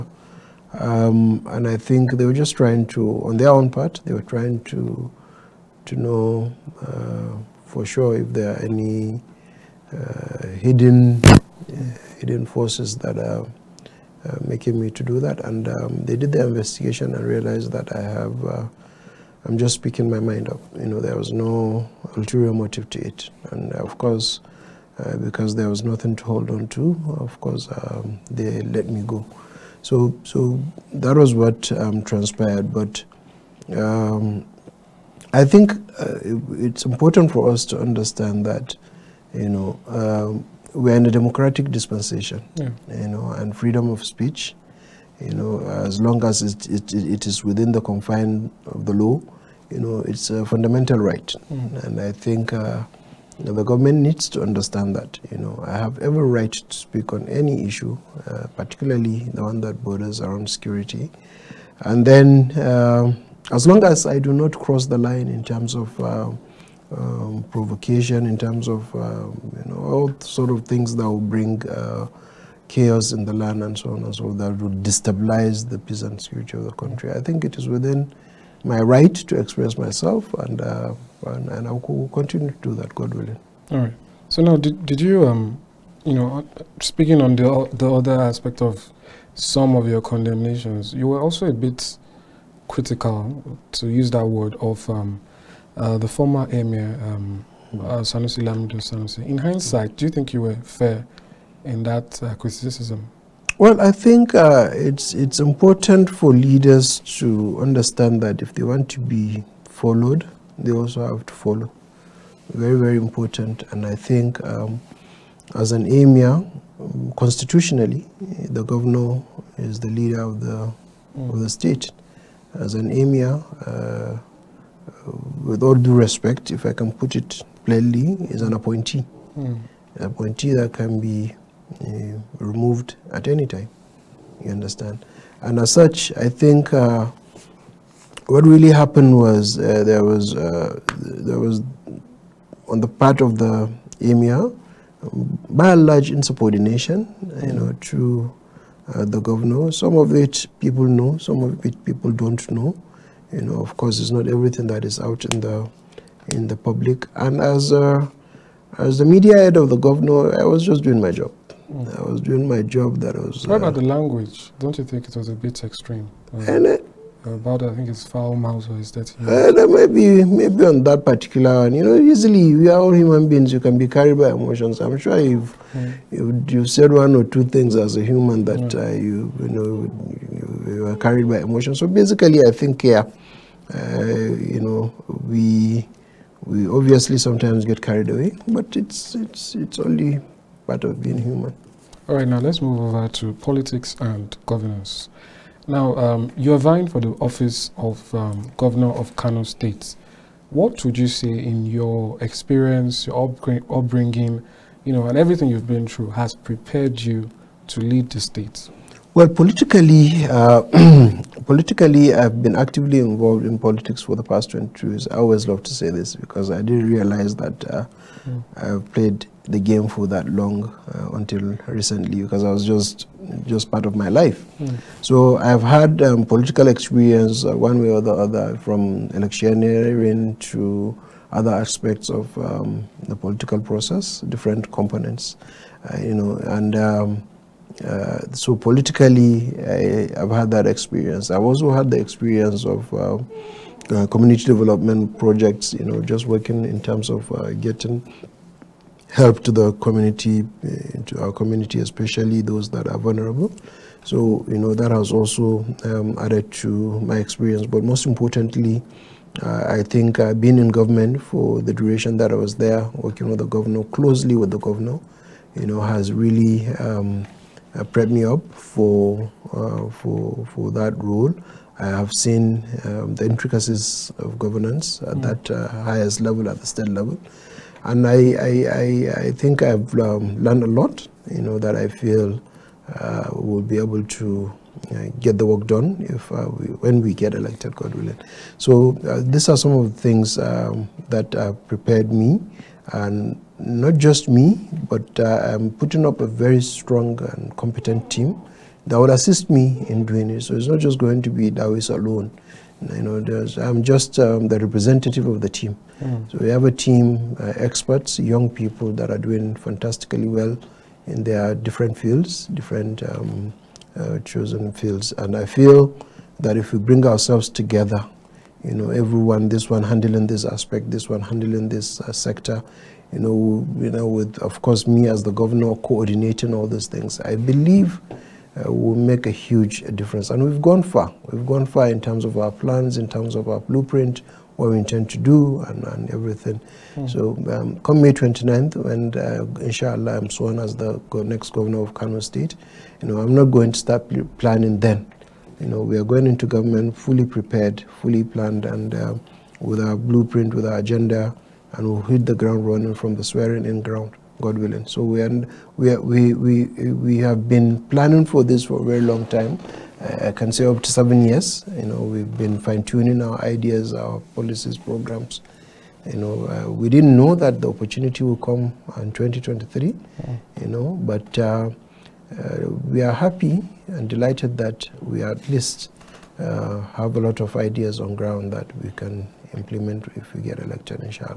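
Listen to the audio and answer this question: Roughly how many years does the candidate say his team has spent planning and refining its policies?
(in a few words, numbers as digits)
7.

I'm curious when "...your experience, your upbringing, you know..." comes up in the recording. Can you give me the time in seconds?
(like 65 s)
201 s.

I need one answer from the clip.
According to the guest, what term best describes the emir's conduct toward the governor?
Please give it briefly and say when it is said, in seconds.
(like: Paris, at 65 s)
Insubordination, at 146 s.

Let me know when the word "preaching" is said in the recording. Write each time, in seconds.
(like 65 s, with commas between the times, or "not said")
not said.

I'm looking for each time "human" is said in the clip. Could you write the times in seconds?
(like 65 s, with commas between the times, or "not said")
172 s, 178 s, 191 s.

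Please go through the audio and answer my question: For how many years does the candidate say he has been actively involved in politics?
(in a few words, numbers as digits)
22.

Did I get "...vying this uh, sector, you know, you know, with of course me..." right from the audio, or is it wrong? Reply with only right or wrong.
wrong.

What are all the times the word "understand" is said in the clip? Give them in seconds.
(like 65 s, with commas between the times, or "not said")
37 s, 54 s, 107 s, 134 s.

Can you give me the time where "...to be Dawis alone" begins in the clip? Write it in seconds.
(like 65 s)
301 s.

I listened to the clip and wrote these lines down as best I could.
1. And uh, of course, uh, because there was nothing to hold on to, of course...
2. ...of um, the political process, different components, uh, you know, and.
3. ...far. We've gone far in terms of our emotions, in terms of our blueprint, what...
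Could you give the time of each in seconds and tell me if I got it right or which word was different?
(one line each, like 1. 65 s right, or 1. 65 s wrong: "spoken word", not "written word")
1. 23 s right
2. 232 s right
3. 330 s wrong: "plans", not "emotions".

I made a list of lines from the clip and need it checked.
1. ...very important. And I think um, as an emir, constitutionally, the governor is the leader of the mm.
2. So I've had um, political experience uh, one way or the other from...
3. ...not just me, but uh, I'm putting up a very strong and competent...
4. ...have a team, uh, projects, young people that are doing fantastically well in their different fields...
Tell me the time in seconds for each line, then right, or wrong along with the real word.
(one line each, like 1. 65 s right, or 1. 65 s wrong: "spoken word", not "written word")
1. 112 s right
2. 225 s right
3. 293 s right
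4. 306 s wrong: "experts", not "projects".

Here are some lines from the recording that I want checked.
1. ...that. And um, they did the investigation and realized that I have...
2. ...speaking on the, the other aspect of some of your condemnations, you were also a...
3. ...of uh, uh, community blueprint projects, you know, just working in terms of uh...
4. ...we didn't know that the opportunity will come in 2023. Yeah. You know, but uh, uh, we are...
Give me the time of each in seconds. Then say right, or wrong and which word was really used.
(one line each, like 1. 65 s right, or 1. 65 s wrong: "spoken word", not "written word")
1. 15 s right
2. 86 s right
3. 242 s wrong: "development", not "blueprint"
4. 366 s right.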